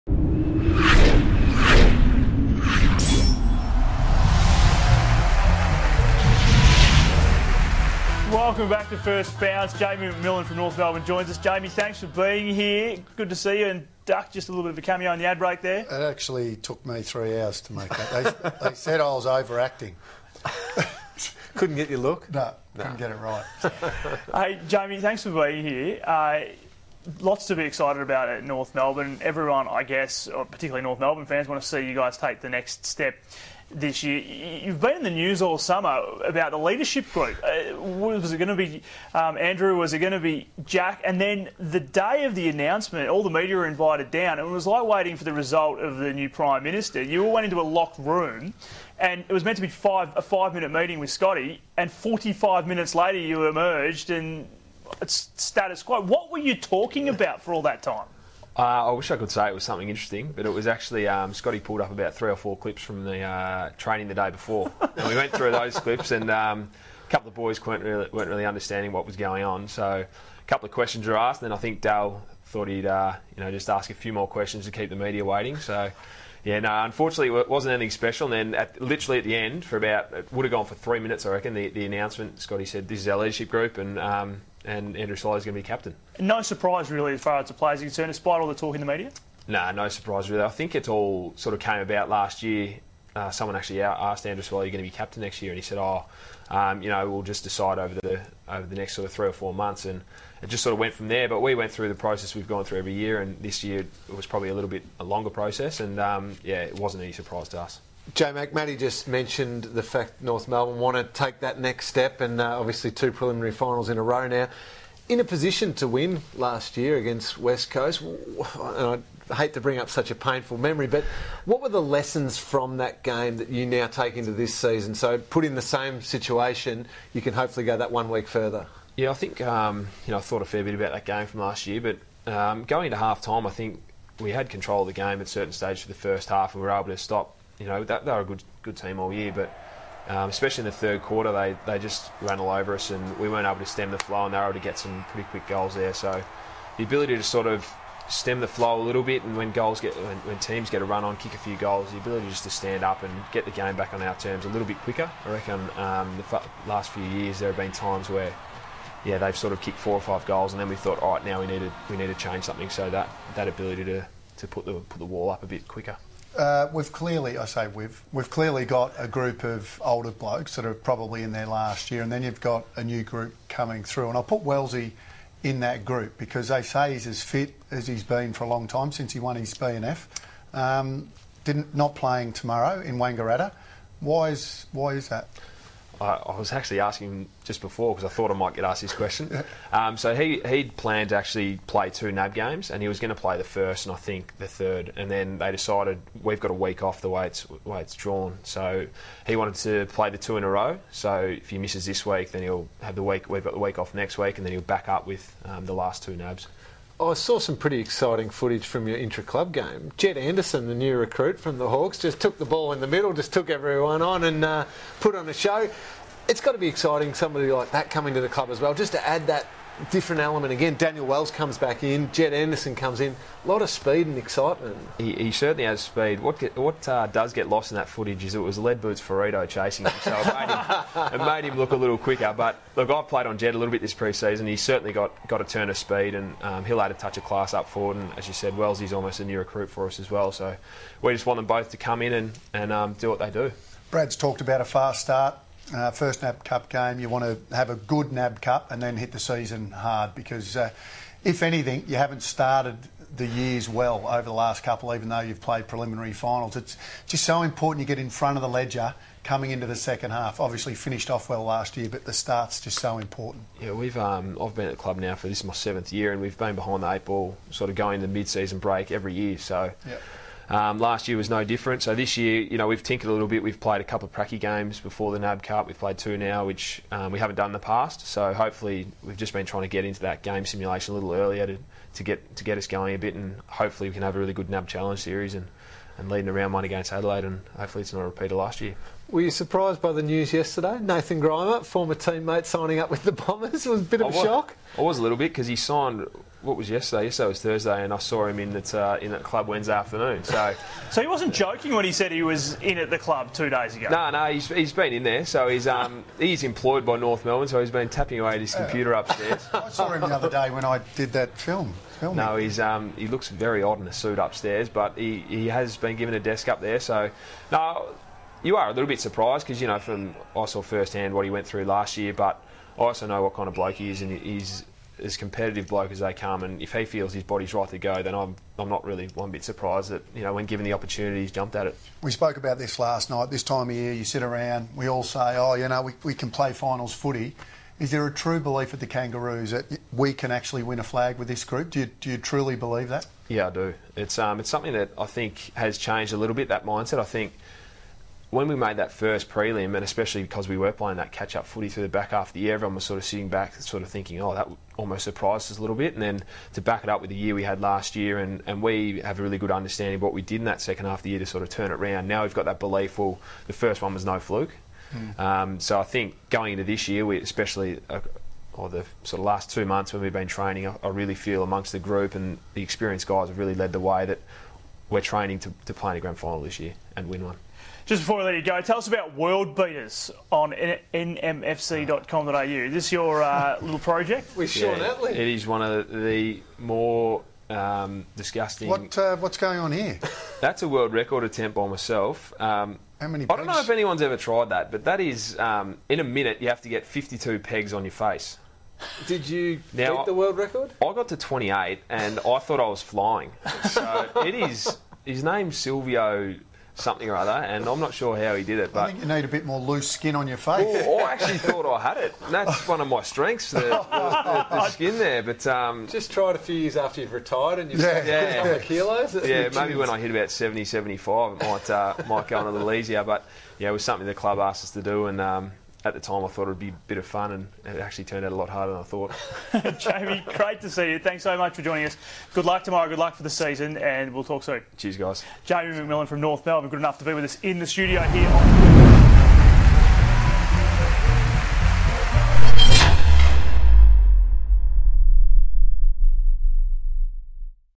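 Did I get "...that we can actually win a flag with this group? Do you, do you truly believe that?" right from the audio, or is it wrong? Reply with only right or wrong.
right.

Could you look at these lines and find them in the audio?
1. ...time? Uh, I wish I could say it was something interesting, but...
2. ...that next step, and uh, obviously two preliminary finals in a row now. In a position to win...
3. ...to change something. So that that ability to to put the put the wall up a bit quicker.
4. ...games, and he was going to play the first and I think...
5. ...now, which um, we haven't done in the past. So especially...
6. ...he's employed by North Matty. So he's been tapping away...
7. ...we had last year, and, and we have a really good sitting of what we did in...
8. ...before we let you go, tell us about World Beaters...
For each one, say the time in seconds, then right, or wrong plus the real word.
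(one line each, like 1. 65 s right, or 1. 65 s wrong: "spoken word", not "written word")
1. 57 s right
2. 111 s right
3. 162 s right
4. 192 s right
5. 276 s wrong: "hopefully", not "especially"
6. 306 s wrong: "Melbourne", not "Matty"
7. 357 s wrong: "understanding", not "sitting"
8. 378 s right.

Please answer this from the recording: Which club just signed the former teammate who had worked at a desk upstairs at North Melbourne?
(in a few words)
Bombers.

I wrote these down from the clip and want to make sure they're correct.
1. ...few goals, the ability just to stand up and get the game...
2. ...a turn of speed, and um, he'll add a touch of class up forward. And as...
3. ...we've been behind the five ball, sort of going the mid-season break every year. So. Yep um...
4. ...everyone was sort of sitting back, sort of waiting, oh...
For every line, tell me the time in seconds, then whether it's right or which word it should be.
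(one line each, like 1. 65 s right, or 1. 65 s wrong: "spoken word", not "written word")
1. 151 s right
2. 235 s right
3. 266 s wrong: "eight", not "five"
4. 352 s wrong: "thinking", not "waiting".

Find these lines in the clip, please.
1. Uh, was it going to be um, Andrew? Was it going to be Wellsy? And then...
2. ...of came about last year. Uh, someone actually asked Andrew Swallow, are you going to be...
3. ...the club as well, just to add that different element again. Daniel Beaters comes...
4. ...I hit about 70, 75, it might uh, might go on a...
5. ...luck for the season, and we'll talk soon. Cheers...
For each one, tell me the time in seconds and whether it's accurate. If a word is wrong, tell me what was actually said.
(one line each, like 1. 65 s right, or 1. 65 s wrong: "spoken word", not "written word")
1. 37 s wrong: "Jack", not "Wellsy"
2. 91 s right
3. 218 s wrong: "Wells", not "Beaters"
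4. 419 s right
5. 432 s right.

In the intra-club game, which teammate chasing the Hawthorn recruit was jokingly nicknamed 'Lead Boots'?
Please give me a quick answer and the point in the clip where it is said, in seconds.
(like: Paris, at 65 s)
Firrito, at 228 s.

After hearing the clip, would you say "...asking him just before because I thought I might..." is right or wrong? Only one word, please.
right.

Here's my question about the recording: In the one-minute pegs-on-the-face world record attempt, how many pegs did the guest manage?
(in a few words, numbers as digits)
28.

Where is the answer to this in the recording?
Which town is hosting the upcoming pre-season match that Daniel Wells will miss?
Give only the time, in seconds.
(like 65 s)
182 s.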